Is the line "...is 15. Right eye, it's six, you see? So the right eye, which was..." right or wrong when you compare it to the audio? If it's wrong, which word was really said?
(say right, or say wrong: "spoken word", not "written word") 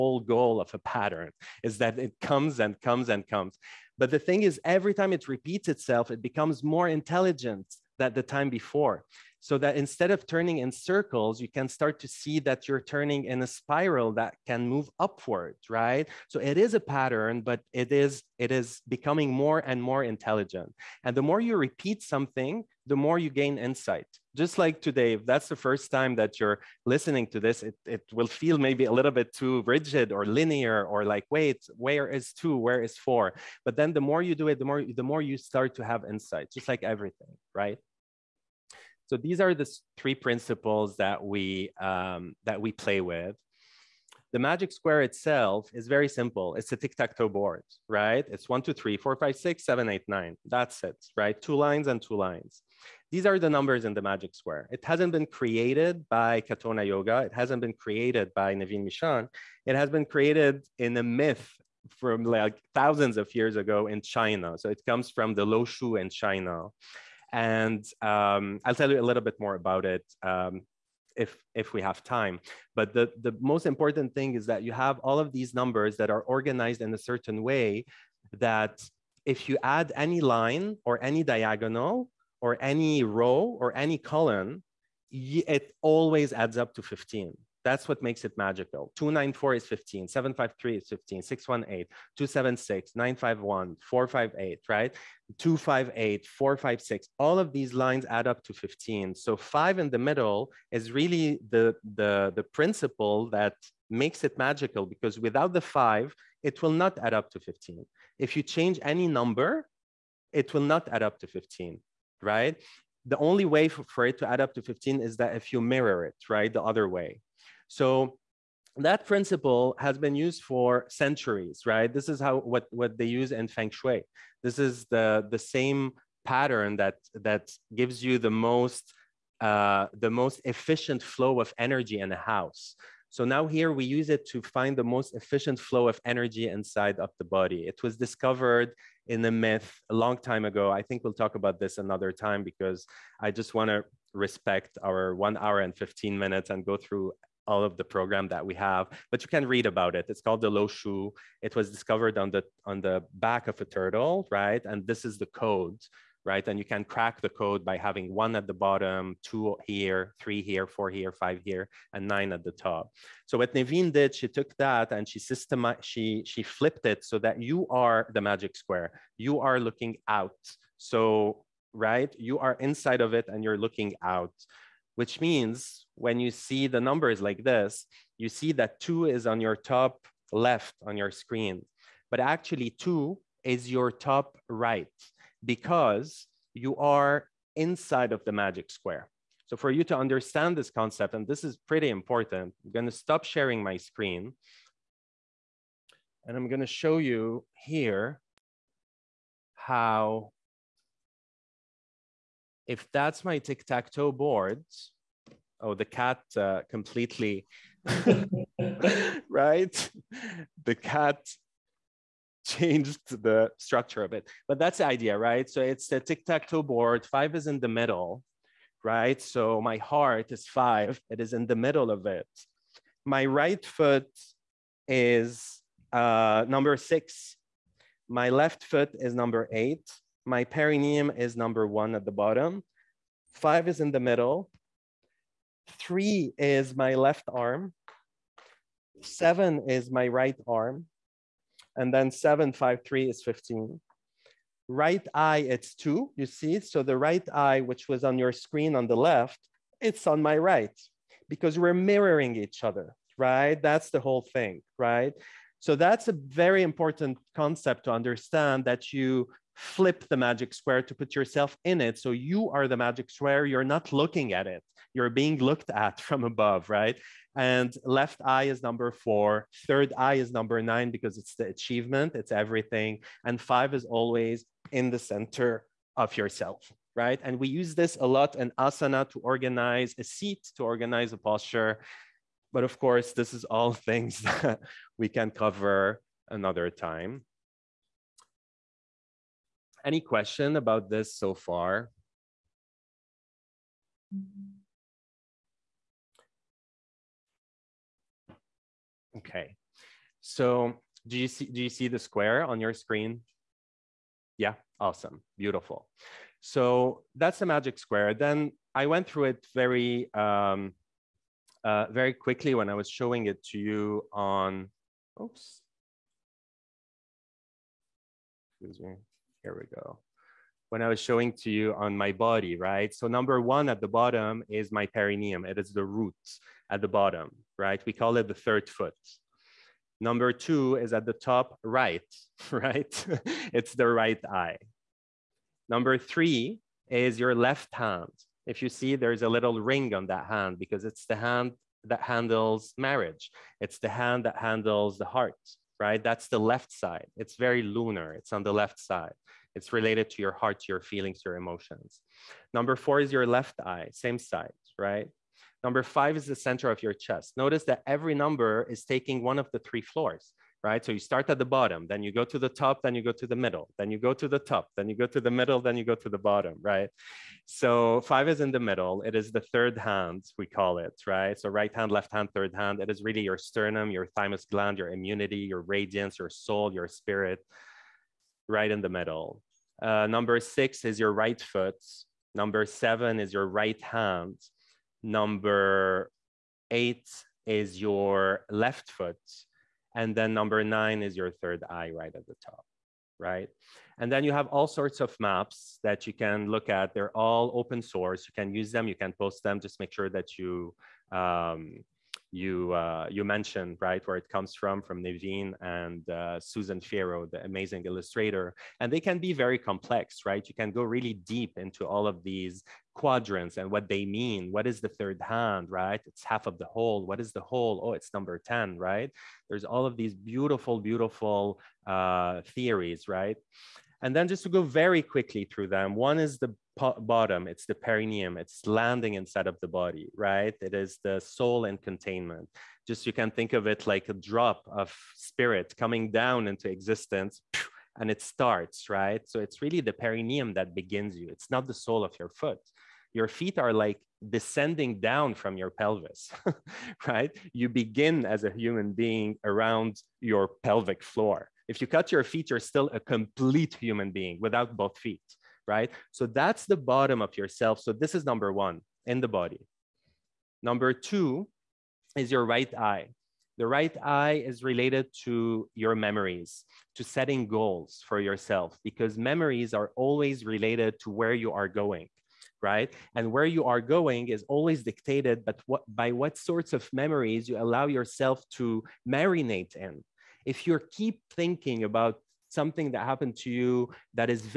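wrong: "two", not "six".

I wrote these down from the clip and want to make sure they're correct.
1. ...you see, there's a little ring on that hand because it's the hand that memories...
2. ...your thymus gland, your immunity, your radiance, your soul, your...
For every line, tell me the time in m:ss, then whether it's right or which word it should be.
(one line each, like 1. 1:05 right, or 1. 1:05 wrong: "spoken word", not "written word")
1. 5:38 wrong: "handles", not "memories"
2. 6:13 right.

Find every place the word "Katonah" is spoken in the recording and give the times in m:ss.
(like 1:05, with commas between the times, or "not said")
0:56.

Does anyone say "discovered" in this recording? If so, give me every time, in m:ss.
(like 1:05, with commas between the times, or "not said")
2:17, 2:31.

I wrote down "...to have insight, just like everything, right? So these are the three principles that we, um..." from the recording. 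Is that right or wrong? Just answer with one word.
right.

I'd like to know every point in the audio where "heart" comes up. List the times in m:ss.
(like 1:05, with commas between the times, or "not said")
3:39, 5:45, 5:50.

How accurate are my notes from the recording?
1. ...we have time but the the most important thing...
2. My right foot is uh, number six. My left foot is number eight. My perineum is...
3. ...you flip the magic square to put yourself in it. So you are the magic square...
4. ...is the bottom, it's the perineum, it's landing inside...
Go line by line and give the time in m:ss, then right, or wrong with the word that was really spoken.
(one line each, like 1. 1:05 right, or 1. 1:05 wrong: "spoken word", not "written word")
1. 1:11 right
2. 3:43 right
3. 4:18 right
4. 7:06 right.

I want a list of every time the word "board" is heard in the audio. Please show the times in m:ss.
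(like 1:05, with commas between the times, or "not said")
0:47, 3:24, 3:36.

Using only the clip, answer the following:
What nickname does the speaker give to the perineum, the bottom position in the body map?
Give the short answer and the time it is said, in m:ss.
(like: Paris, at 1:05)
The third foot, at 5:27.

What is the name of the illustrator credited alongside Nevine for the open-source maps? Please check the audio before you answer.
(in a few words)
Susan Fierro.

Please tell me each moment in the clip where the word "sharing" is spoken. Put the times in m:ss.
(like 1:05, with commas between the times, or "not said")
3:13.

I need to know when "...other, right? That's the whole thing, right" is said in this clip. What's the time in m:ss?
4:12.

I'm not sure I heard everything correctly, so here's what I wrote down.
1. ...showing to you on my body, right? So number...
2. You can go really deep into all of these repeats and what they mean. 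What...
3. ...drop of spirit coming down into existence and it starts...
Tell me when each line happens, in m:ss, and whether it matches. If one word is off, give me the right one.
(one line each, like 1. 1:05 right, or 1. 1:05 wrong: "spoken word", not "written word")
1. 5:20 right
2. 6:50 wrong: "quadrants", not "repeats"
3. 7:14 right.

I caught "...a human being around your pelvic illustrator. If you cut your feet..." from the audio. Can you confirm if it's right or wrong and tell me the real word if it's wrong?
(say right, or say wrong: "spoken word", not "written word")
wrong: "floor", not "illustrator".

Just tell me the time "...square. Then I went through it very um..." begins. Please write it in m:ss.
5:07.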